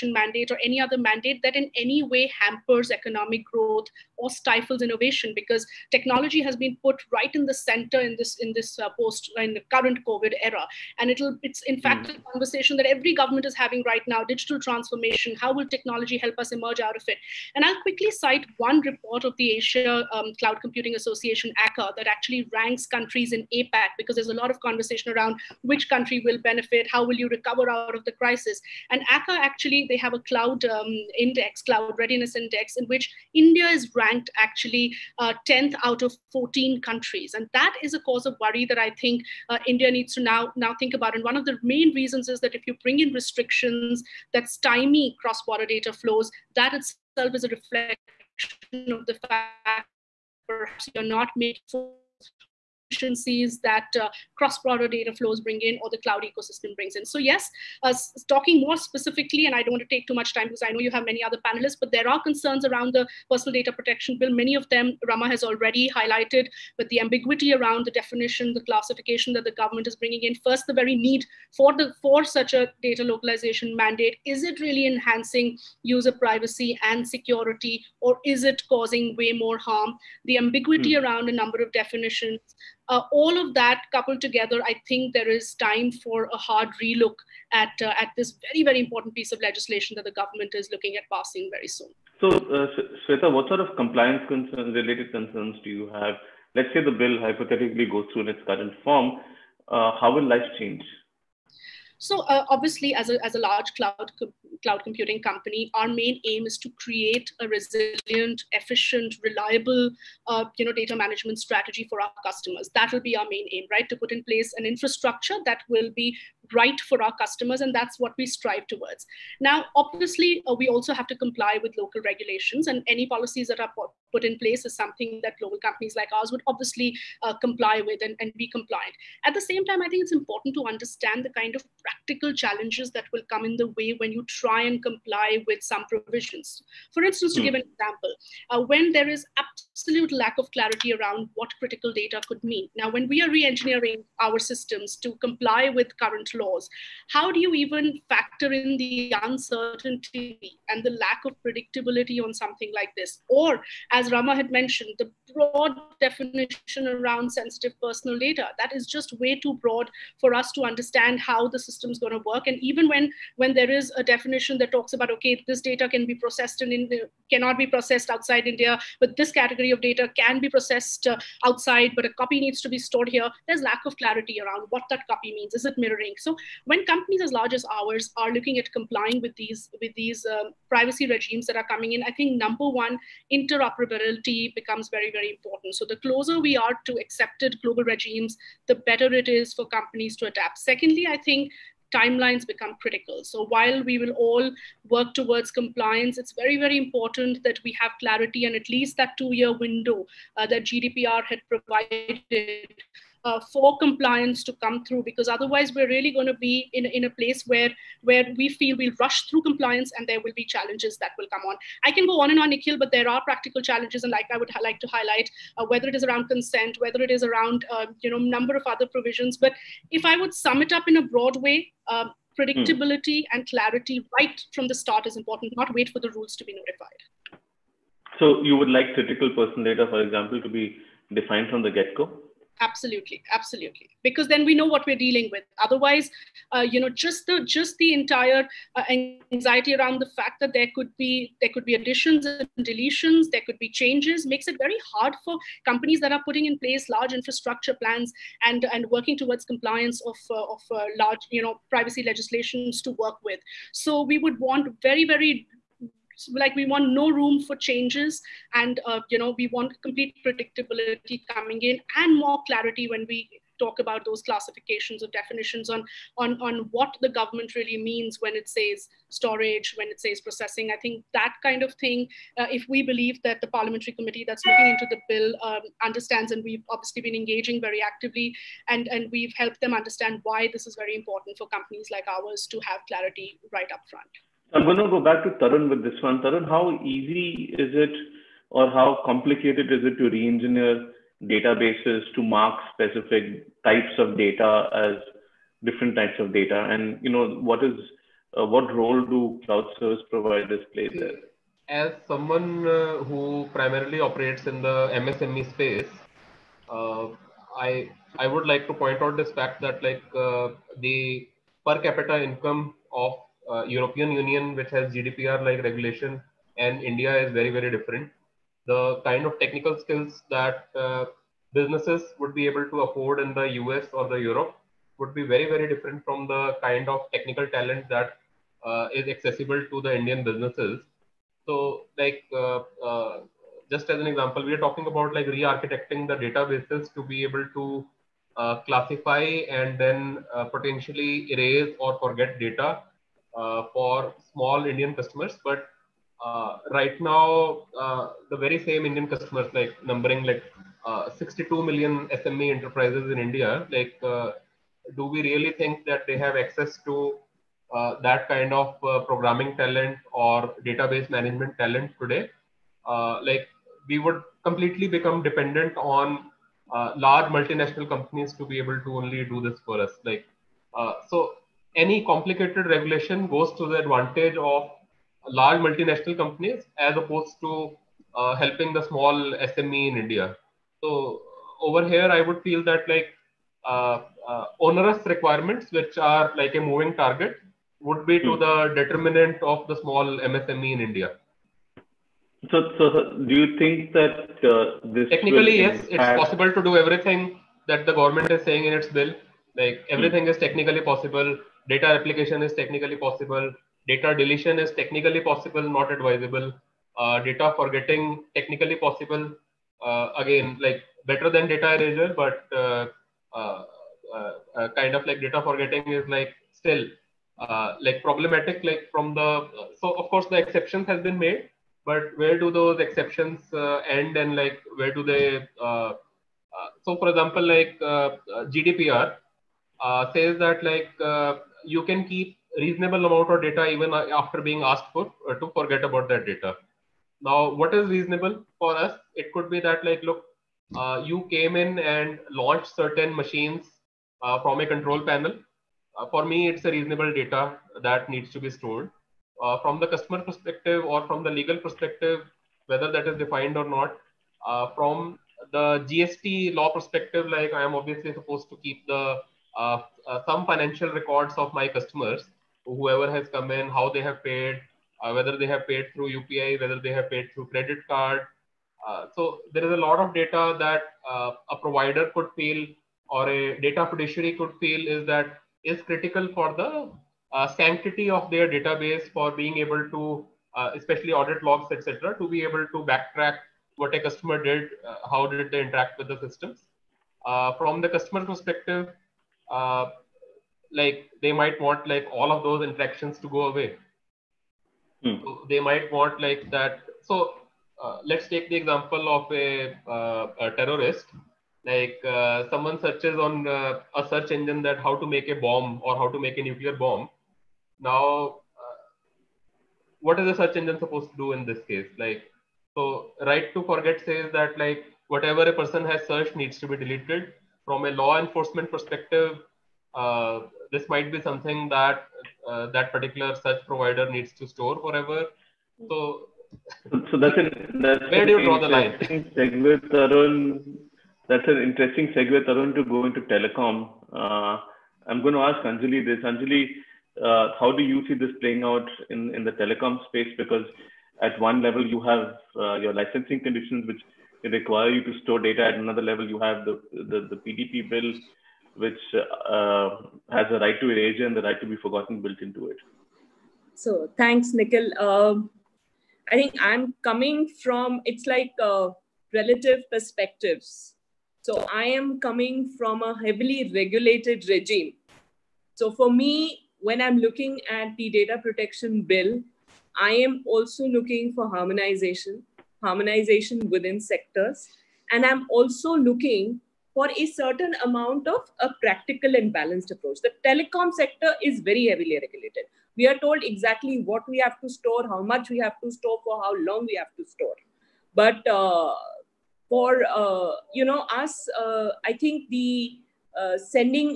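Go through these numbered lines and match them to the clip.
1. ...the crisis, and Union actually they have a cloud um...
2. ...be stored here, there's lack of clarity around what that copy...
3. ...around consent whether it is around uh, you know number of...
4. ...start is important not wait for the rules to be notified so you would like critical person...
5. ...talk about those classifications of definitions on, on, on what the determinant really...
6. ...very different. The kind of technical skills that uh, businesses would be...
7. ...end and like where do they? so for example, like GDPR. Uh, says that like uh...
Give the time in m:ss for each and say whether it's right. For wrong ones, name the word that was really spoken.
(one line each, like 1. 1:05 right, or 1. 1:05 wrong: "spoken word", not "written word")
1. 0:28 wrong: "ACA", not "Union"
2. 2:52 right
3. 3:36 right
4. 3:44 right
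5. 4:23 wrong: "government", not "determinant"
6. 5:17 right
7. 7:03 right.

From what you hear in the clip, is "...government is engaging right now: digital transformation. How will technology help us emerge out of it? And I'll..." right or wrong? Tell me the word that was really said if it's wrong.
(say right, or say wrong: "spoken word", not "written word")
wrong: "having", not "engaging".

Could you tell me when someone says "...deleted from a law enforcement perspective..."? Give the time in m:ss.
8:36.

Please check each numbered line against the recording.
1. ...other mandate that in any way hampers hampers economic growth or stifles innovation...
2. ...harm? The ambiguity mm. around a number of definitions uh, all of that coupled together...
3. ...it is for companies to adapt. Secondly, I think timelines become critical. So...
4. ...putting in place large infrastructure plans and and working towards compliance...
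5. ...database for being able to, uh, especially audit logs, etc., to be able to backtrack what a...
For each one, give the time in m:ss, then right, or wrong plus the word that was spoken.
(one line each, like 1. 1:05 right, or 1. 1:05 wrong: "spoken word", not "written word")
1. 0:00 right
2. 1:19 right
3. 3:09 right
4. 4:06 right
5. 7:58 right.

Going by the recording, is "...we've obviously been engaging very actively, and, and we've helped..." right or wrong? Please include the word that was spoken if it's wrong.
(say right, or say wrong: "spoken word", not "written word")
right.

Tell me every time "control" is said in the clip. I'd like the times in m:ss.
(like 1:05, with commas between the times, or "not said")
7:24.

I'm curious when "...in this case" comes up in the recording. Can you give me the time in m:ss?
8:31.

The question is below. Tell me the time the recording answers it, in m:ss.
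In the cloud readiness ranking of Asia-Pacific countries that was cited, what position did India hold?
0:35.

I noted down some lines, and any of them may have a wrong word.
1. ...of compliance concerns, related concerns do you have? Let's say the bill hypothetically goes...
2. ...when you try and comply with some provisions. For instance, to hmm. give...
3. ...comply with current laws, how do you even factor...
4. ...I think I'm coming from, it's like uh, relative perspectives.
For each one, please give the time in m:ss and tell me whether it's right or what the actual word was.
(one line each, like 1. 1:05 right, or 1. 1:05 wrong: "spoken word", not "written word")
1. 1:33 right
2. 2:13 right
3. 2:25 right
4. 9:16 right.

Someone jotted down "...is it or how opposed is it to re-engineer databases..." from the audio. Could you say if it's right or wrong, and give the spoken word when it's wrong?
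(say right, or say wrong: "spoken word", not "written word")
wrong: "complicated", not "opposed".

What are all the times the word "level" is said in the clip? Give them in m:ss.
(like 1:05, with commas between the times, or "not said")
9:01, 9:06.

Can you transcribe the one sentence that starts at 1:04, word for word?
Many of them Rama has already highlighted, but the ambiguity around the definition, the classification that the government is bringing in.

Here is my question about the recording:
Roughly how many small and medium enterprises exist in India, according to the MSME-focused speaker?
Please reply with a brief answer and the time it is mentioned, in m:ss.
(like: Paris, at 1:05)
62 million, at 5:51.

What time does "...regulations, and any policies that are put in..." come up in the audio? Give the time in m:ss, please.
2:02.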